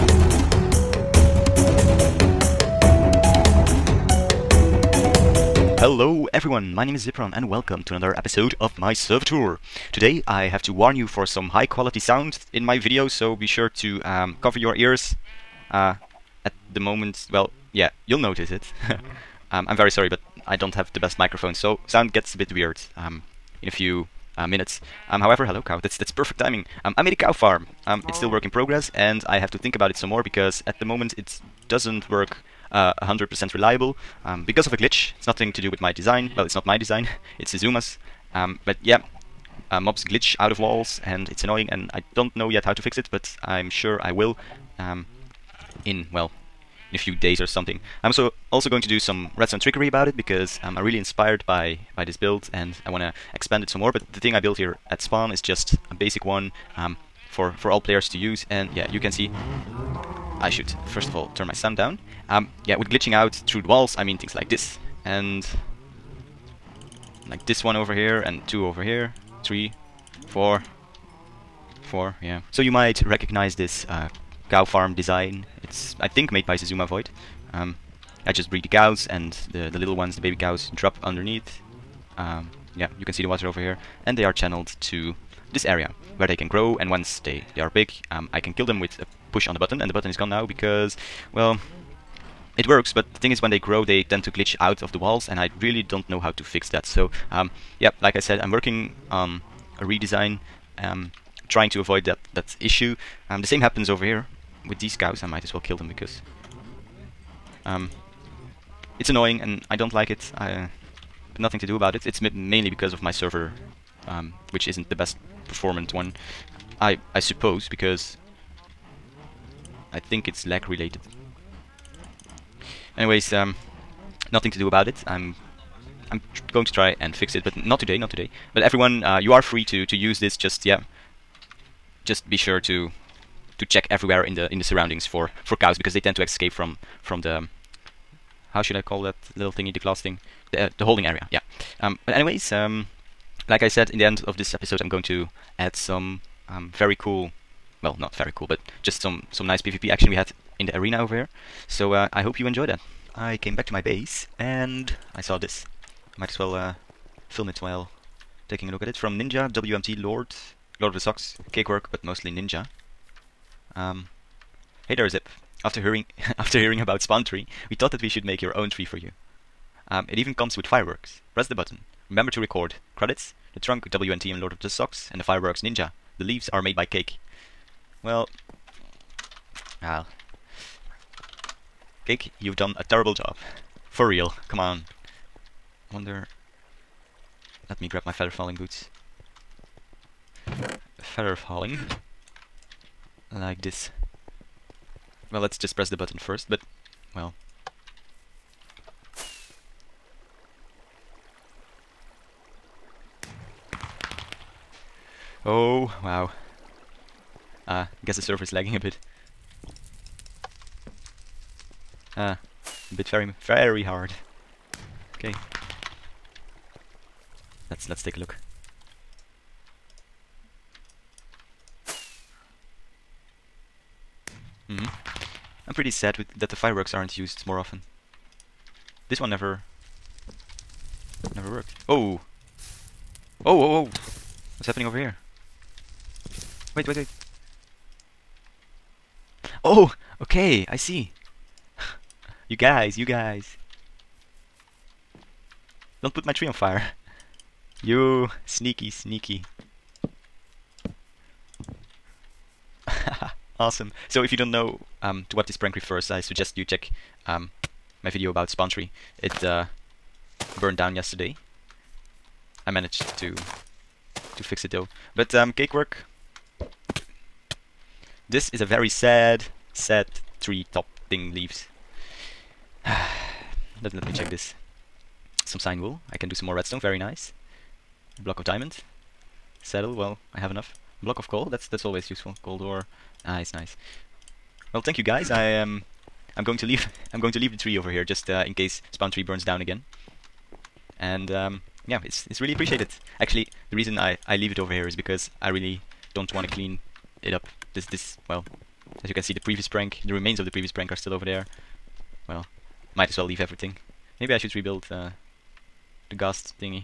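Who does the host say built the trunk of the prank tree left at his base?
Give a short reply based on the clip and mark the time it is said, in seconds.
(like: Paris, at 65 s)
WNT and Lord of the Socks, at 173 s.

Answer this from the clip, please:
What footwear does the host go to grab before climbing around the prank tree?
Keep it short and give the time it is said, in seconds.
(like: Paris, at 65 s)
Feather falling boots, at 188 s.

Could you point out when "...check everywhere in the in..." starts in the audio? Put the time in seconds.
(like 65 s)
133 s.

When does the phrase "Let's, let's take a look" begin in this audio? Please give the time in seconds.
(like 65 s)
217 s.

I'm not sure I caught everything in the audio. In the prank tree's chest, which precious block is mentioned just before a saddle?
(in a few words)
Block of diamond.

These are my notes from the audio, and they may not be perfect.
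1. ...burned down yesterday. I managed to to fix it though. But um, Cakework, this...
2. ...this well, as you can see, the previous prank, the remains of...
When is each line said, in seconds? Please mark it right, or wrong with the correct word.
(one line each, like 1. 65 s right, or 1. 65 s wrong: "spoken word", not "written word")
1. 260 s right
2. 297 s right.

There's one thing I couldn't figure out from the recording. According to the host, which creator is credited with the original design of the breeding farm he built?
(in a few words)
Zuzuma Void.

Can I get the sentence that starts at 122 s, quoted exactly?
Anyways, um, nothing to do about it.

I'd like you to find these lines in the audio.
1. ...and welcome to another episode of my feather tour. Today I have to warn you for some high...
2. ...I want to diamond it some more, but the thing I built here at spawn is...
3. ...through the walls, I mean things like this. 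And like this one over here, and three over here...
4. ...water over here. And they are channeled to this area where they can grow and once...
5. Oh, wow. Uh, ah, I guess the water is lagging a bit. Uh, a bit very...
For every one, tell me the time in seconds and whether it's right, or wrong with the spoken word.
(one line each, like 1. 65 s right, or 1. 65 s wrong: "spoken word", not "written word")
1. 7 s wrong: "server", not "feather"
2. 52 s wrong: "expand", not "diamond"
3. 63 s wrong: "two", not "three"
4. 83 s right
5. 205 s wrong: "server", not "water".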